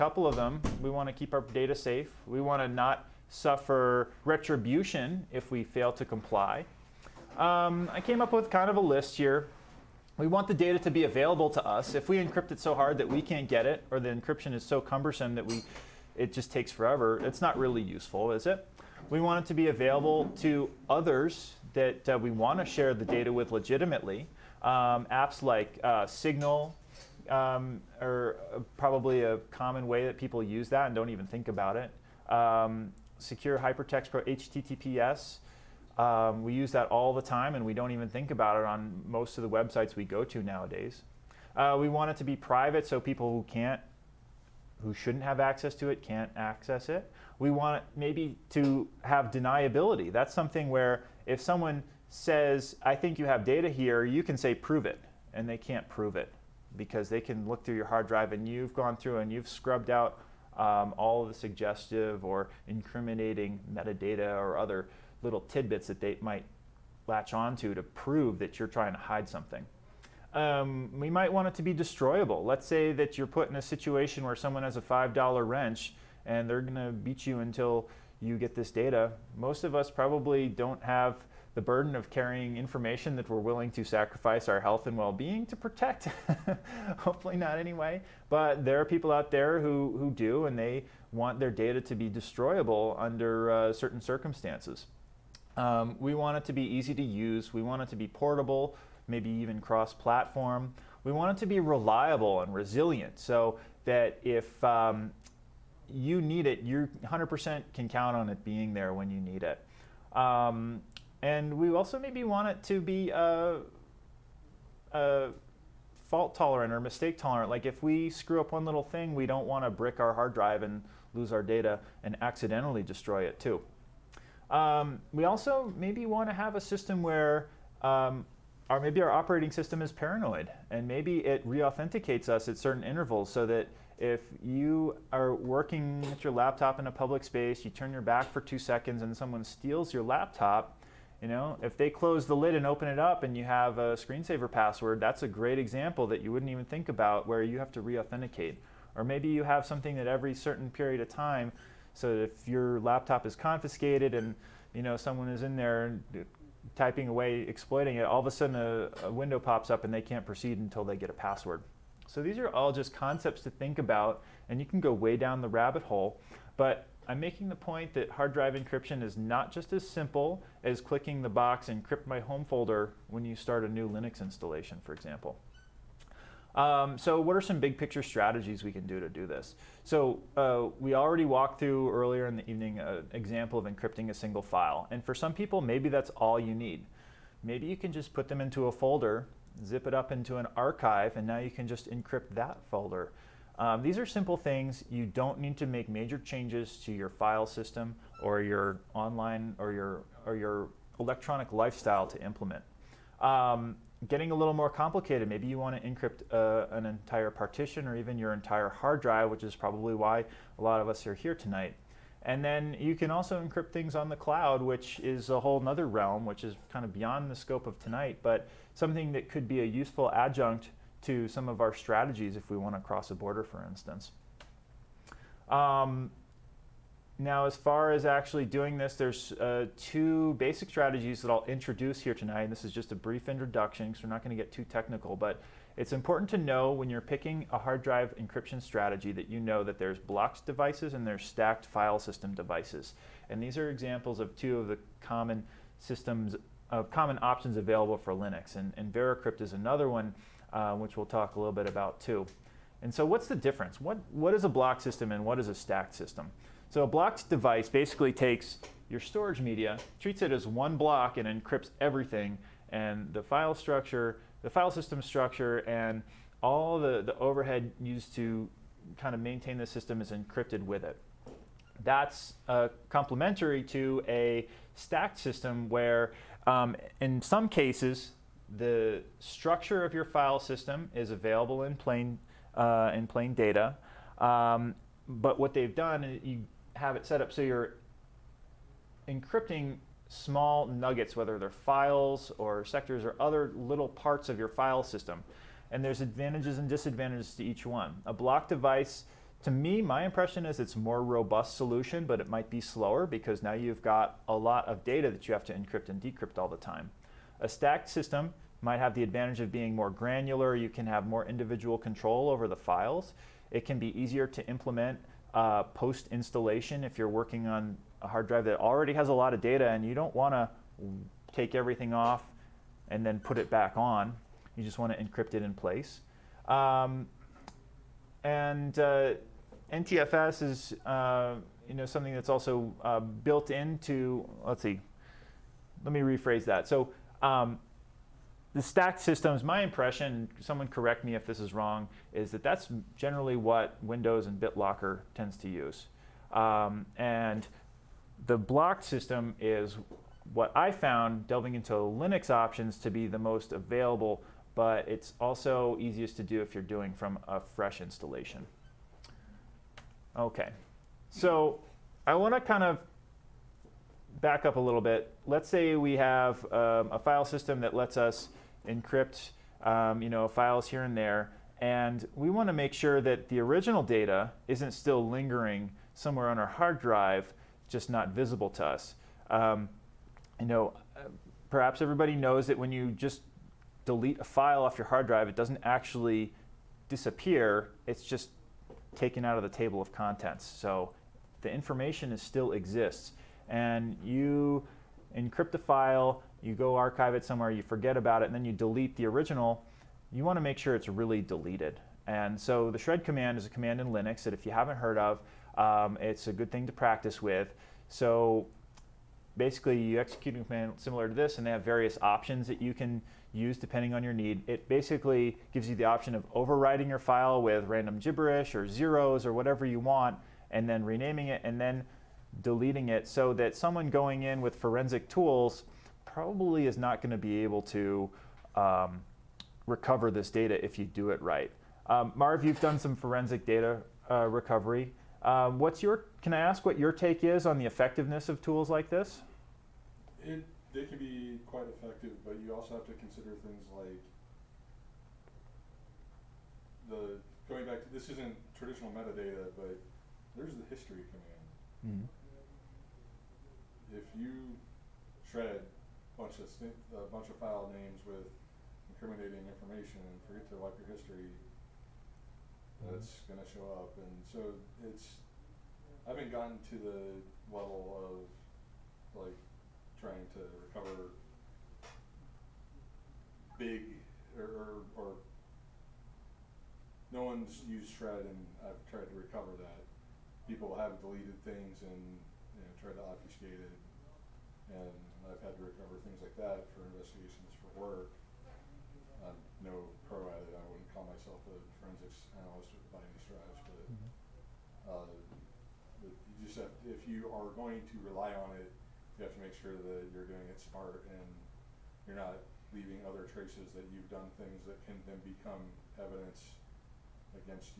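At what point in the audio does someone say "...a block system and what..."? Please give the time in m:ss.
4:14.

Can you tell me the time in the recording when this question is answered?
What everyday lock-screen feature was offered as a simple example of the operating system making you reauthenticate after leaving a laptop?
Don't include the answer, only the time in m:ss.
2:23.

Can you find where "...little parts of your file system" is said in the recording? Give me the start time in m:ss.
4:53.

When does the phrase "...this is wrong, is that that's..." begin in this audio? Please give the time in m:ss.
5:41.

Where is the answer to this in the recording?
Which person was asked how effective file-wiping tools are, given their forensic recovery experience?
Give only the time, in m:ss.
7:12.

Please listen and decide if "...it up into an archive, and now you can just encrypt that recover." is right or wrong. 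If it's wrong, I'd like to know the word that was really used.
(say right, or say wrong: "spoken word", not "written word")
wrong: "folder", not "recover".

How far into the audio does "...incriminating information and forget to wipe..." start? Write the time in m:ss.
7:38.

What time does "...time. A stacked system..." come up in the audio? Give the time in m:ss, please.
5:06.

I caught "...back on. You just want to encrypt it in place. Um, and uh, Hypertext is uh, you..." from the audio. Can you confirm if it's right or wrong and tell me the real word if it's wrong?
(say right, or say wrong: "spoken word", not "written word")
wrong: "NTFS", not "Hypertext".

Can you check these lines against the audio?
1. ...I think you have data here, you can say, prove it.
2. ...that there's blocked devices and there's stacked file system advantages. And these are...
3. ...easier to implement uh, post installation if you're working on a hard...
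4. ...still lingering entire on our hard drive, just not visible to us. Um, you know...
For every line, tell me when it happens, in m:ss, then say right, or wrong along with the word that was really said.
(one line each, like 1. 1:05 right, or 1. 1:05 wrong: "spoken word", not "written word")
1. 0:52 right
2. 3:59 wrong: "devices", not "advantages"
3. 5:13 right
4. 6:14 wrong: "somewhere", not "entire".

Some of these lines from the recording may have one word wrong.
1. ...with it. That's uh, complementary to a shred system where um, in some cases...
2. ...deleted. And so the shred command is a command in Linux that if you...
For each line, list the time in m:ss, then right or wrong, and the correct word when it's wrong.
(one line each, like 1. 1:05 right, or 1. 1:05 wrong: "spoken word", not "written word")
1. 4:30 wrong: "stacked", not "shred"
2. 6:41 right.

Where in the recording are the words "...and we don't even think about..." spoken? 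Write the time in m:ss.
0:37.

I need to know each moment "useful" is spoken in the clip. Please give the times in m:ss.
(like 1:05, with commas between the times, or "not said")
0:17, 3:39.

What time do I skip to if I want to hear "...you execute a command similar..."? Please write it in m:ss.
6:49.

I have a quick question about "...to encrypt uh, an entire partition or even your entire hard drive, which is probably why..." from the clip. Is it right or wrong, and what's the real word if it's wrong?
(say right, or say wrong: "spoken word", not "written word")
right.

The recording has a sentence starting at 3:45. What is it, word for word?
Um, now, as far as actually doing this, there's uh, two basic strategies that I'll introduce here tonight.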